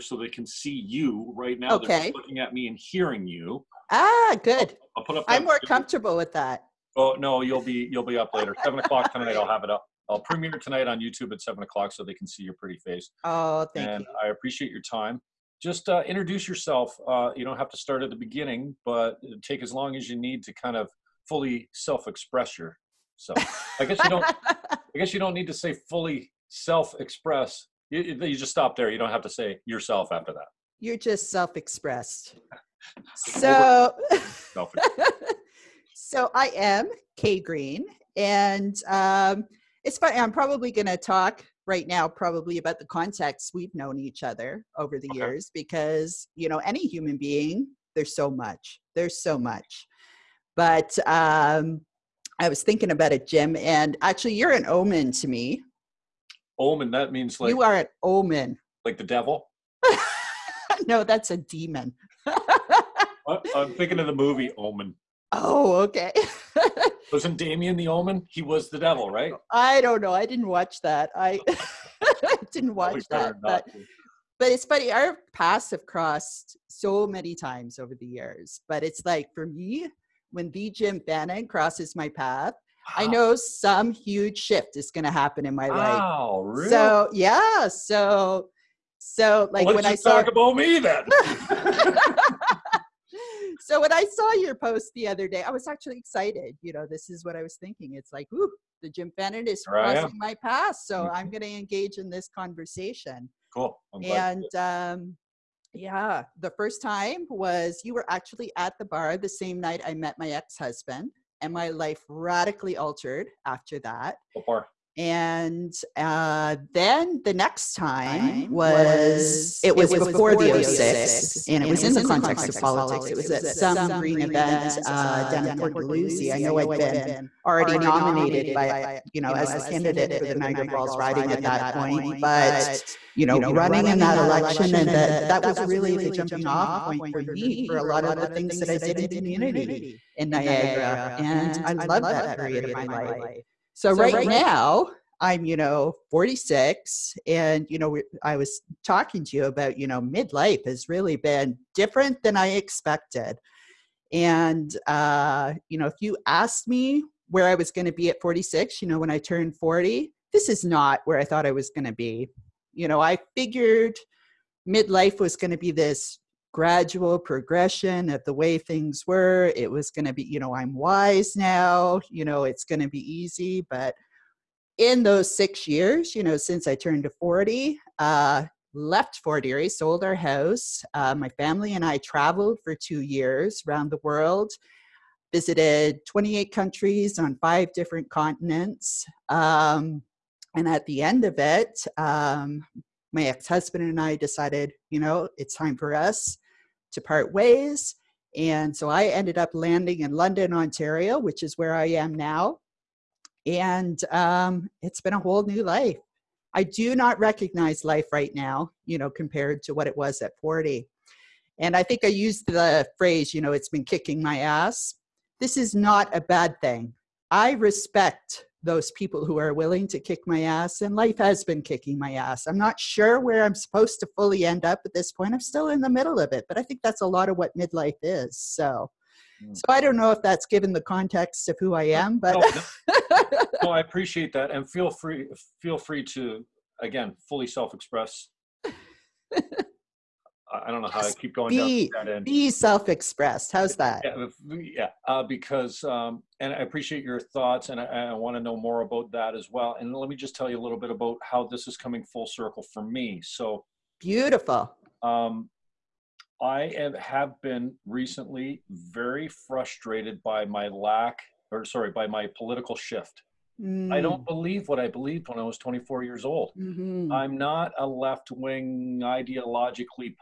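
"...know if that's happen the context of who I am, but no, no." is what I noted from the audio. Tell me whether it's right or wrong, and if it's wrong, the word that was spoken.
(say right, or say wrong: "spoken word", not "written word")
wrong: "given", not "happen".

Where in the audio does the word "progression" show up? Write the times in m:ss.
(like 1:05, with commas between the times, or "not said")
2:47.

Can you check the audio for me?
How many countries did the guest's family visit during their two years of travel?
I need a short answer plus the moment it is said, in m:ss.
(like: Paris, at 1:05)
28, at 3:06.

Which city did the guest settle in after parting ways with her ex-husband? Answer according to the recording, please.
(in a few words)
London, Ontario.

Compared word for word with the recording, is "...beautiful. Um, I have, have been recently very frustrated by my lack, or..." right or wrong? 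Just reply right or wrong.
right.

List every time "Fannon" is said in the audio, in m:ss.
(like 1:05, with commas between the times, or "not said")
1:21, 1:39.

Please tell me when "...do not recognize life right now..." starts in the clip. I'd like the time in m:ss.
3:26.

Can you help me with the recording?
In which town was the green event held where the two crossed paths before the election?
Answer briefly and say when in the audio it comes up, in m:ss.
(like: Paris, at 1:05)
Port Dalhousie, at 2:05.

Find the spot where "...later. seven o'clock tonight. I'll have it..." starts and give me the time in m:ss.
0:08.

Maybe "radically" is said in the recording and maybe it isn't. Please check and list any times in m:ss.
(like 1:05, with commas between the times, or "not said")
1:52.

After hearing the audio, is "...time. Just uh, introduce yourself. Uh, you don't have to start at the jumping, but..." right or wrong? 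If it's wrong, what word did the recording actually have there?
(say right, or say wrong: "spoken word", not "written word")
wrong: "beginning", not "jumping".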